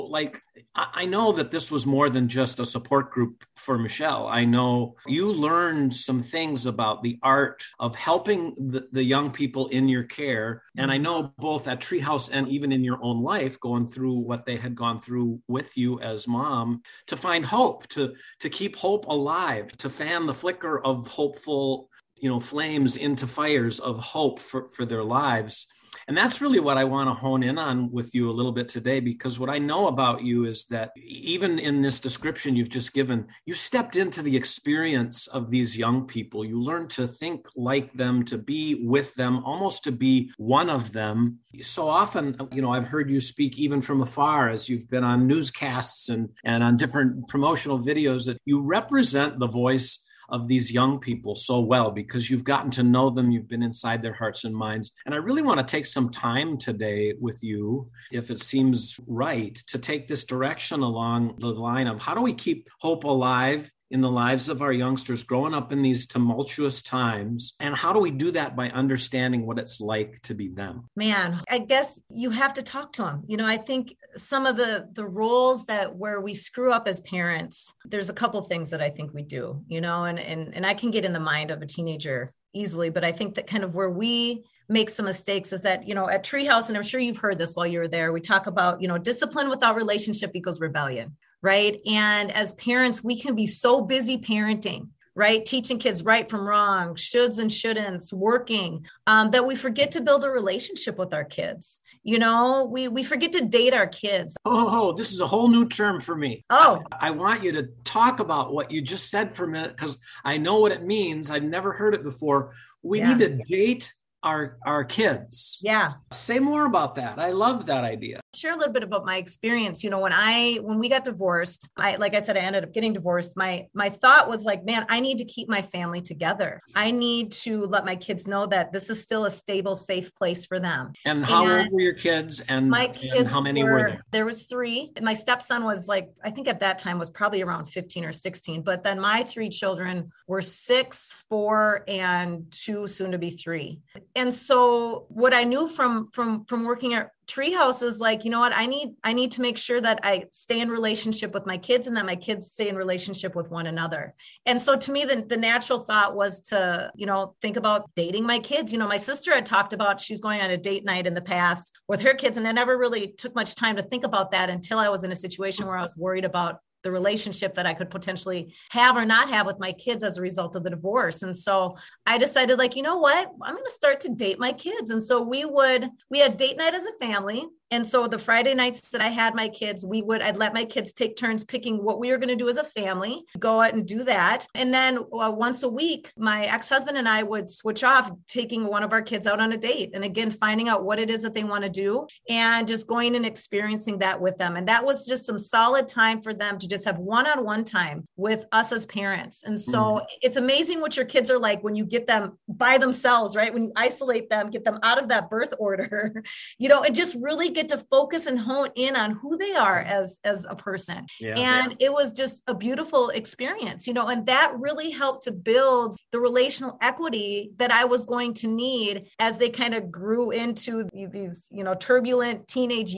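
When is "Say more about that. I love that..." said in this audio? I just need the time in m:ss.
1:56.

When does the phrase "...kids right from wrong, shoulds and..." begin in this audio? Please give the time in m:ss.
1:35.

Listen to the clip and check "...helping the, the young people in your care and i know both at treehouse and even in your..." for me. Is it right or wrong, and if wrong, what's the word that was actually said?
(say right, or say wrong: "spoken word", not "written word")
right.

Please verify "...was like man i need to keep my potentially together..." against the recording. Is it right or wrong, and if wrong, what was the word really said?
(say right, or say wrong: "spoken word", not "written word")
wrong: "family", not "potentially".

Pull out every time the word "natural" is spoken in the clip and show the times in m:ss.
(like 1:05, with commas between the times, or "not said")
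2:35.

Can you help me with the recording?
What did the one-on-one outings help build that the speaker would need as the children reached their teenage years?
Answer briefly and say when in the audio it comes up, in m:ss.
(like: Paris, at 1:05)
relational equity, at 3:36.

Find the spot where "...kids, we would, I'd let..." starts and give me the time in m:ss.
2:59.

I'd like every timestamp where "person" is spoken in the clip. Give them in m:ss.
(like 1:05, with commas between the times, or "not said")
3:30.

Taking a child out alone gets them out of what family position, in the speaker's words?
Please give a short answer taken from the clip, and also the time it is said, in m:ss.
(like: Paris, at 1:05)
birth order, at 3:25.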